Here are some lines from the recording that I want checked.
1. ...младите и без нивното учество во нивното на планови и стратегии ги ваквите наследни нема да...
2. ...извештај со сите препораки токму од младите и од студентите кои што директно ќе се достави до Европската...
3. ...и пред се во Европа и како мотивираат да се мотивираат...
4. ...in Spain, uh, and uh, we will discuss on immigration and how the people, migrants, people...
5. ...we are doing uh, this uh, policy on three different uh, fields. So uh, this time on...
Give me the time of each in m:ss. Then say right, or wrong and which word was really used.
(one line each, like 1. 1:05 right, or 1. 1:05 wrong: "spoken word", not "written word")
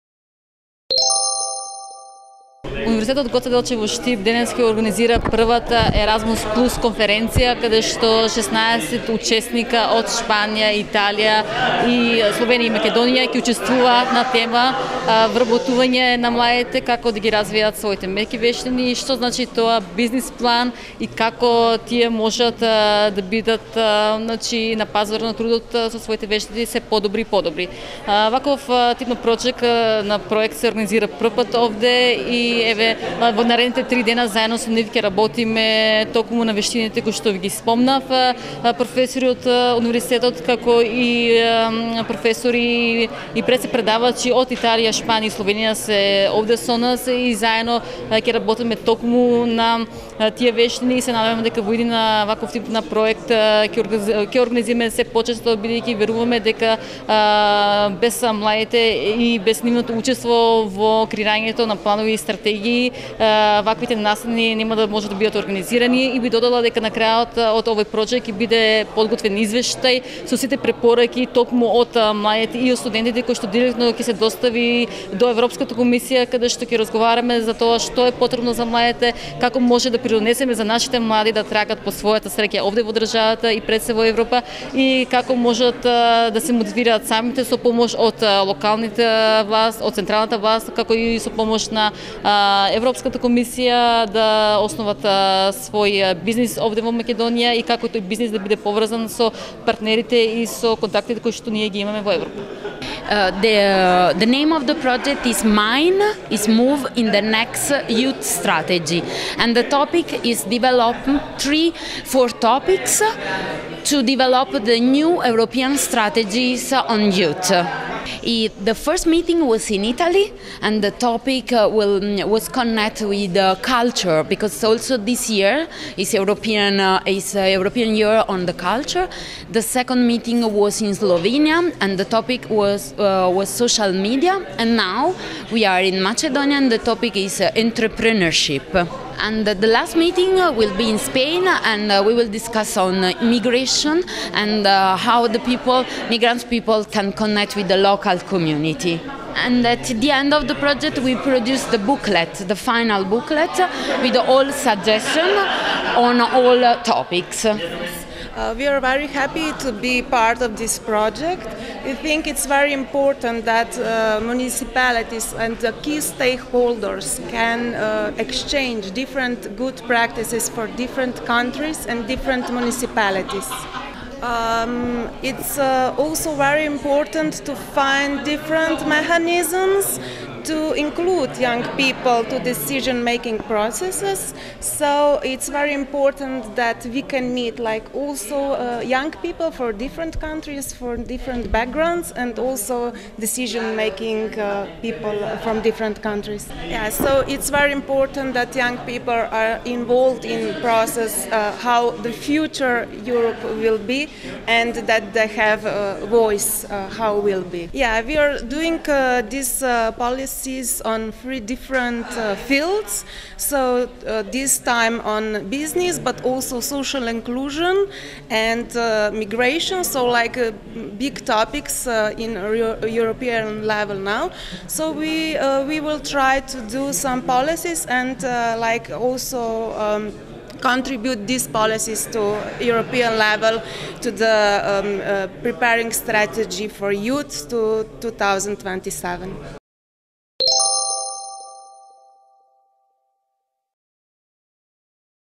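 1. 0:58 wrong: "креирањето", not "нивното"
2. 1:09 right
3. 1:23 wrong: "можат", not "мотивираат"
4. 2:20 right
5. 3:28 right.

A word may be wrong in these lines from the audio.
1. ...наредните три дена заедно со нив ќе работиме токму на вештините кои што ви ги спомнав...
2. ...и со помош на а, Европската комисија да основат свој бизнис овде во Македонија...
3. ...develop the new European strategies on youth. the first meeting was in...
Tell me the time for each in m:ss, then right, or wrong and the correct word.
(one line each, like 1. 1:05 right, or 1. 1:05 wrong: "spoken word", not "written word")
1. 0:33 right
2. 1:30 right
3. 1:54 right.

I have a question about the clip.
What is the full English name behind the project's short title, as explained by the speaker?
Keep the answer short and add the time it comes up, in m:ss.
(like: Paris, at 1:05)
Move in the Next Youth Strategy, at 1:46.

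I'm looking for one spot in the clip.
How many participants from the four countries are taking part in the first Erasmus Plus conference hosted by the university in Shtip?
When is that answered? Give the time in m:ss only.
0:08.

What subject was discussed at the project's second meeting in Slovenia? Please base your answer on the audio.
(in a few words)
Social media.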